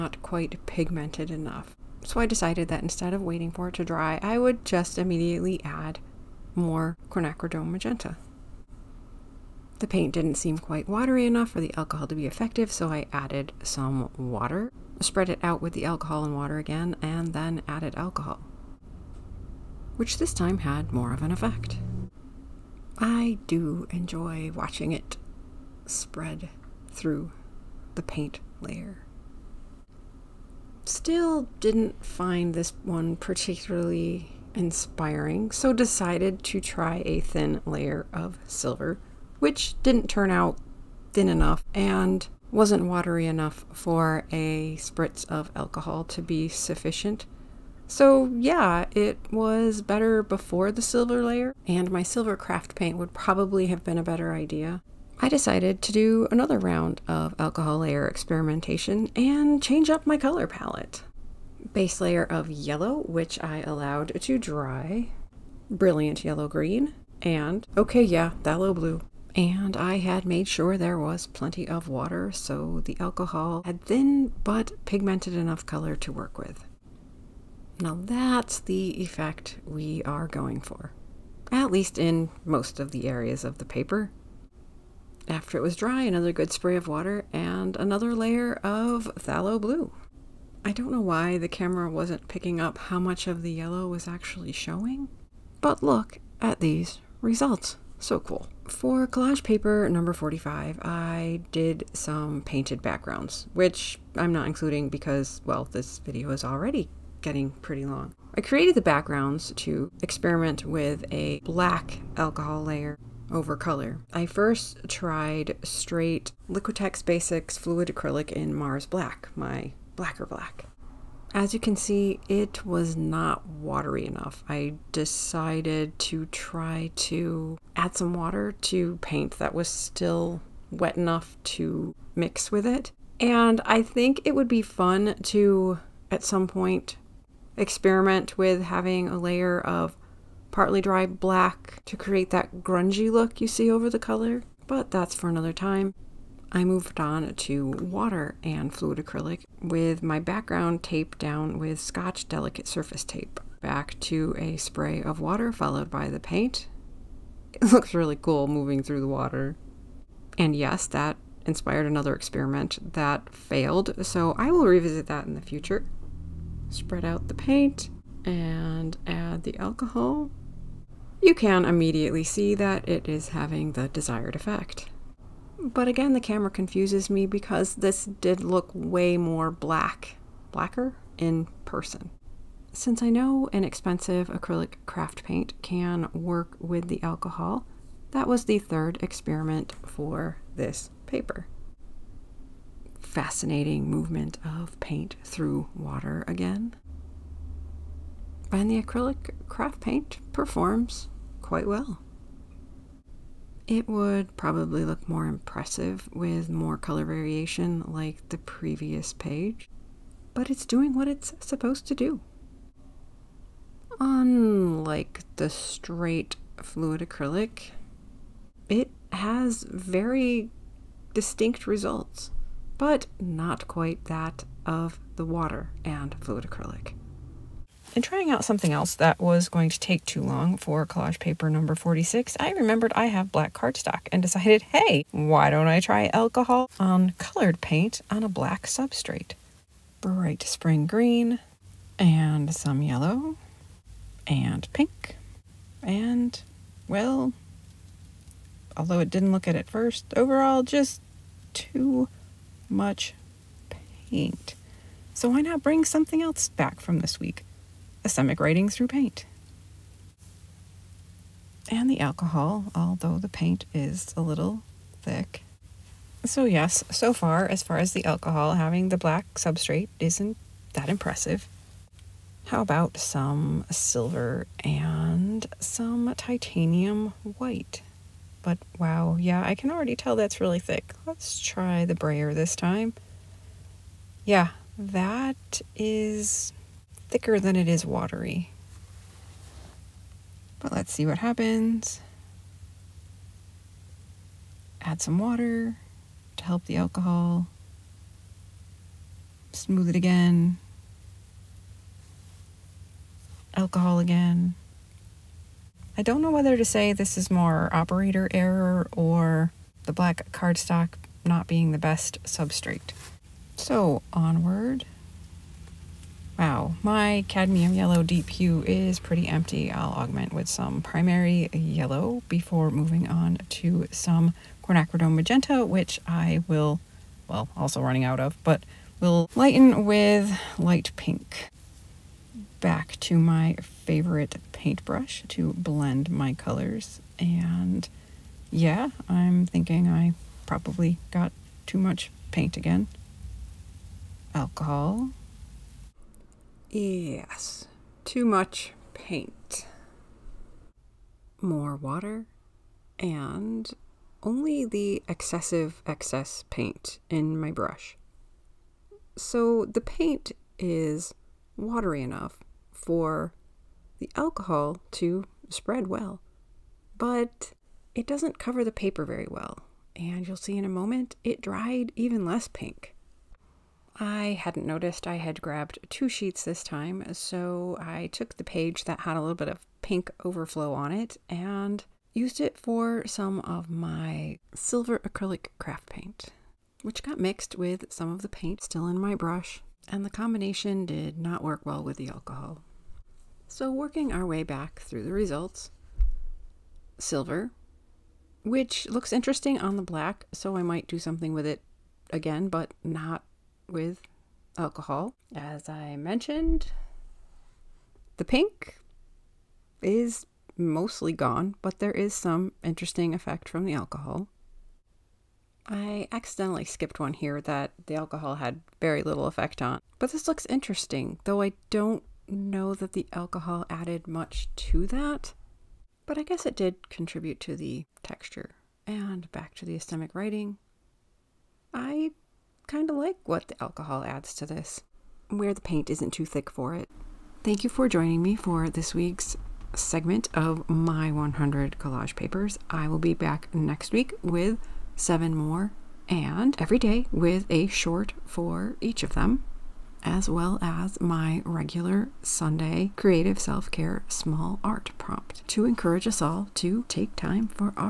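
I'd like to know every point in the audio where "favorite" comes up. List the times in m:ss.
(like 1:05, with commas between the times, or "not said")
5:33.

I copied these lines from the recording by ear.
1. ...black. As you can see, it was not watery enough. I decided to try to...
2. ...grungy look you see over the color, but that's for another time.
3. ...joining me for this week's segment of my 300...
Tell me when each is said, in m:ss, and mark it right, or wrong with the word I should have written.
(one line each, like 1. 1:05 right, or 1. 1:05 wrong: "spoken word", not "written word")
1. 2:00 right
2. 2:22 right
3. 7:17 wrong: "100", not "300".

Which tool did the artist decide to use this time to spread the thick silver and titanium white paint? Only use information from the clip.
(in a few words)
Brayer.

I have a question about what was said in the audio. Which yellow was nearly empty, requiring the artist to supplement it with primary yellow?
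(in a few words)
Cadmium yellow deep hue.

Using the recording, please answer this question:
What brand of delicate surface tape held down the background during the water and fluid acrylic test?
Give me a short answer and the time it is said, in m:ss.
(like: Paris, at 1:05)
Scotch, at 2:31.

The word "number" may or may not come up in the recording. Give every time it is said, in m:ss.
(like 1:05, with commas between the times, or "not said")
1:39, 3:51.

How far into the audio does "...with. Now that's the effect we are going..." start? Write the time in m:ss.
1:16.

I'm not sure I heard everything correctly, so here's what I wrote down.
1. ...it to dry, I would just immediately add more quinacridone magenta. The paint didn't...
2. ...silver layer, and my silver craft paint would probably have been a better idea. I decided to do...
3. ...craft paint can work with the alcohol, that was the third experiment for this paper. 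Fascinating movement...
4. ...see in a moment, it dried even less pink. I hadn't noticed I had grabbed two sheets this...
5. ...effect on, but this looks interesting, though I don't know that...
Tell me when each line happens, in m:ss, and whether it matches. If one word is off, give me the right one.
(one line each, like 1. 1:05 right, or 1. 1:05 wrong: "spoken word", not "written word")
1. 0:03 right
2. 0:50 right
3. 3:04 right
4. 6:10 right
5. 6:59 right.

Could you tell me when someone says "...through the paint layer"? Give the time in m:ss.
0:26.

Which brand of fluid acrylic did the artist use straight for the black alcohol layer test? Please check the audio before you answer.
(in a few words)
Liquitex Basics.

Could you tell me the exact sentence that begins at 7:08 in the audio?
And back to the esthetic writing.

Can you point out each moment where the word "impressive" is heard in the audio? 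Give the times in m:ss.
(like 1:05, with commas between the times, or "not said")
3:25, 4:30.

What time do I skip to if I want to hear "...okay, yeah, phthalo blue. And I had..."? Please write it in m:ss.
1:07.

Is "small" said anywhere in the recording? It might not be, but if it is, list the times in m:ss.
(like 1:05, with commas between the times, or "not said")
7:34.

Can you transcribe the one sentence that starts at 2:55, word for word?
But again, the camera confuses me because this did look way more black, blacker in person.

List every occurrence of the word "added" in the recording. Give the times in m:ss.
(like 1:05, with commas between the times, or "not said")
0:13, 0:17, 7:03.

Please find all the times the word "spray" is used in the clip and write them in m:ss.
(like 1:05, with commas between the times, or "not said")
1:26, 2:34.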